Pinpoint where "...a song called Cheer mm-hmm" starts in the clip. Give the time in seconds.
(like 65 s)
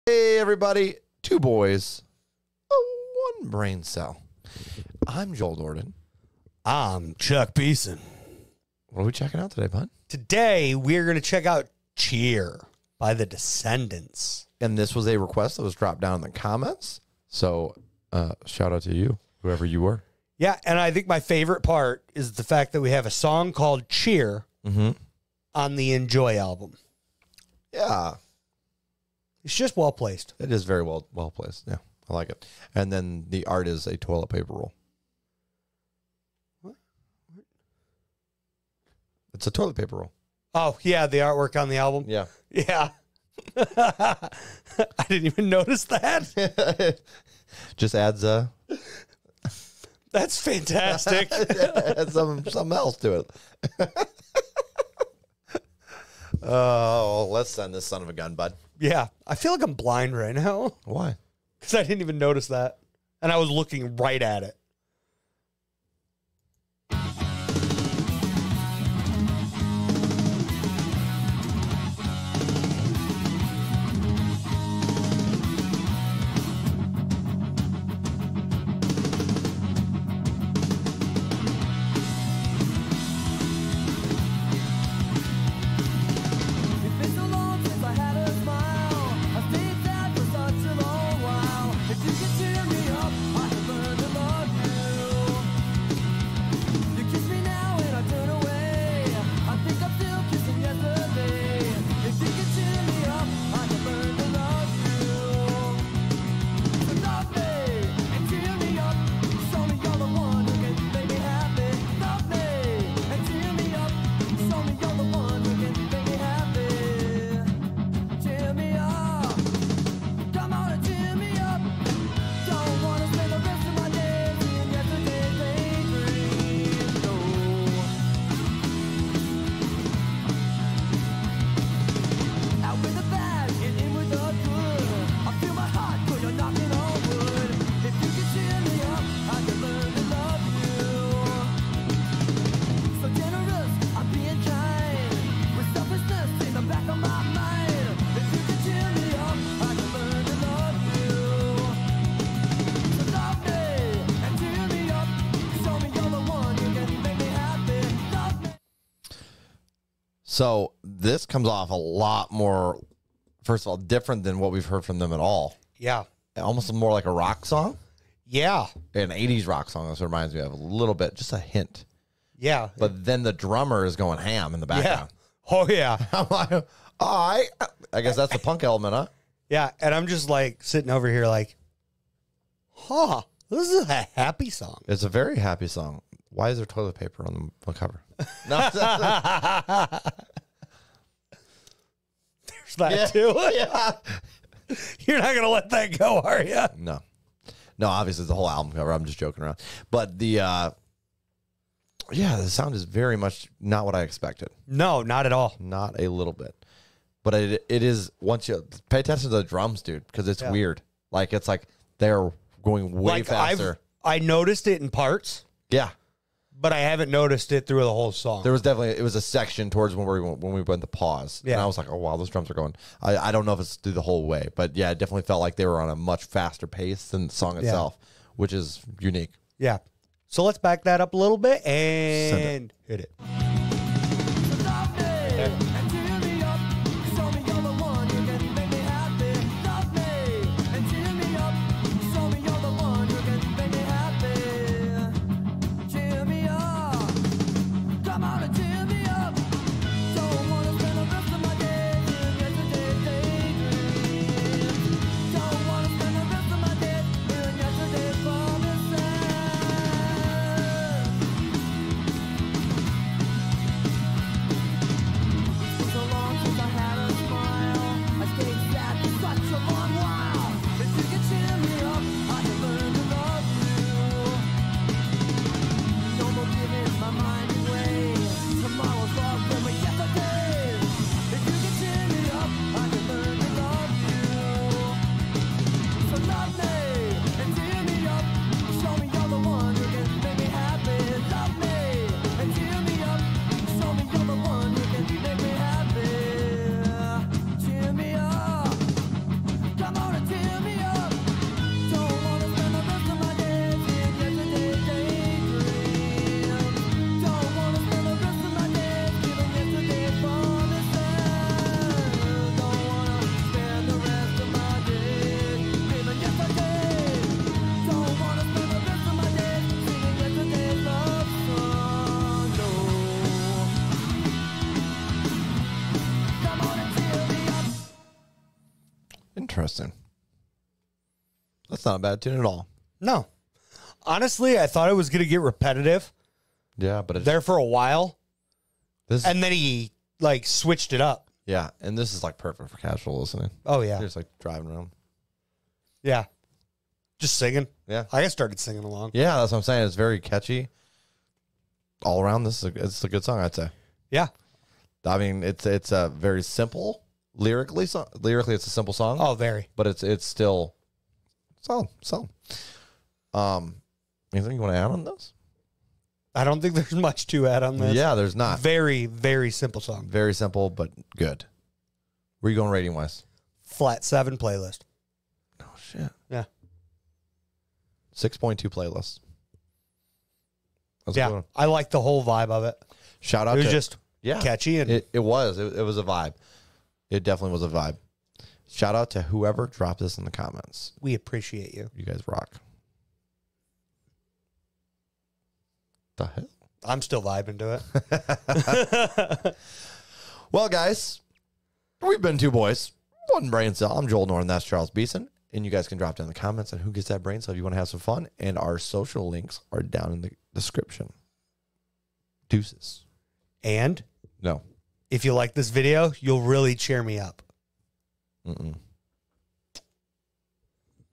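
23 s.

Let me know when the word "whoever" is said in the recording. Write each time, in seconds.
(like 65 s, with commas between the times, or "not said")
19 s, 389 s.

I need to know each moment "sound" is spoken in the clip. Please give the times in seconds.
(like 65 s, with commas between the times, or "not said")
202 s.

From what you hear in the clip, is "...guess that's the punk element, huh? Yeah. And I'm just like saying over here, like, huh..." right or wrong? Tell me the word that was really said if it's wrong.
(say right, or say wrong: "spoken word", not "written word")
wrong: "sitting", not "saying".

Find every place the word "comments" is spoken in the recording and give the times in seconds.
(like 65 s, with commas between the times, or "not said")
16 s, 390 s, 406 s.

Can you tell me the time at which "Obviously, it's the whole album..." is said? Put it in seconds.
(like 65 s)
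197 s.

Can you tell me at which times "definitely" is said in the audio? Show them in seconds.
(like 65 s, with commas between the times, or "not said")
218 s, 224 s, 387 s.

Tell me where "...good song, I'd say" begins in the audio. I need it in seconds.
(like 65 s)
353 s.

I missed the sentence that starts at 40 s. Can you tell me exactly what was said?
Oh yeah, the artwork on the album.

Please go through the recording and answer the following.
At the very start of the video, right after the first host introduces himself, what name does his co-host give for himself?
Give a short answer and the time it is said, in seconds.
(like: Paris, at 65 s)
Chuck Beeson, at 7 s.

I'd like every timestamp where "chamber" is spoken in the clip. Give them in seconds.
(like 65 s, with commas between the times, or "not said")
not said.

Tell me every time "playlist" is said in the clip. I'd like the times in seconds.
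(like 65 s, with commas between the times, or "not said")
374 s, 378 s.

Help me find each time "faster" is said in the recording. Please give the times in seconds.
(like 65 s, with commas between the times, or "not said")
213 s, 226 s.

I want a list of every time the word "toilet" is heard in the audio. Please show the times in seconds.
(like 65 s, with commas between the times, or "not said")
33 s, 39 s, 186 s.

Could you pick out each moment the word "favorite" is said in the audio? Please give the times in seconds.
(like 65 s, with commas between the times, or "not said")
21 s.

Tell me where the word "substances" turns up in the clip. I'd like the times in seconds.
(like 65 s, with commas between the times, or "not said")
not said.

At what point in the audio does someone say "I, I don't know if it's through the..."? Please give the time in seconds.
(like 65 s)
223 s.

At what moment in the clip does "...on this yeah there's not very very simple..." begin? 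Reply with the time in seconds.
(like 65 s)
367 s.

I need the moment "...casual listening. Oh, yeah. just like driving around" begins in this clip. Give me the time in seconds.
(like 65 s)
342 s.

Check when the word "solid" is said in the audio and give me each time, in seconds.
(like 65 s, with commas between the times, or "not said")
362 s.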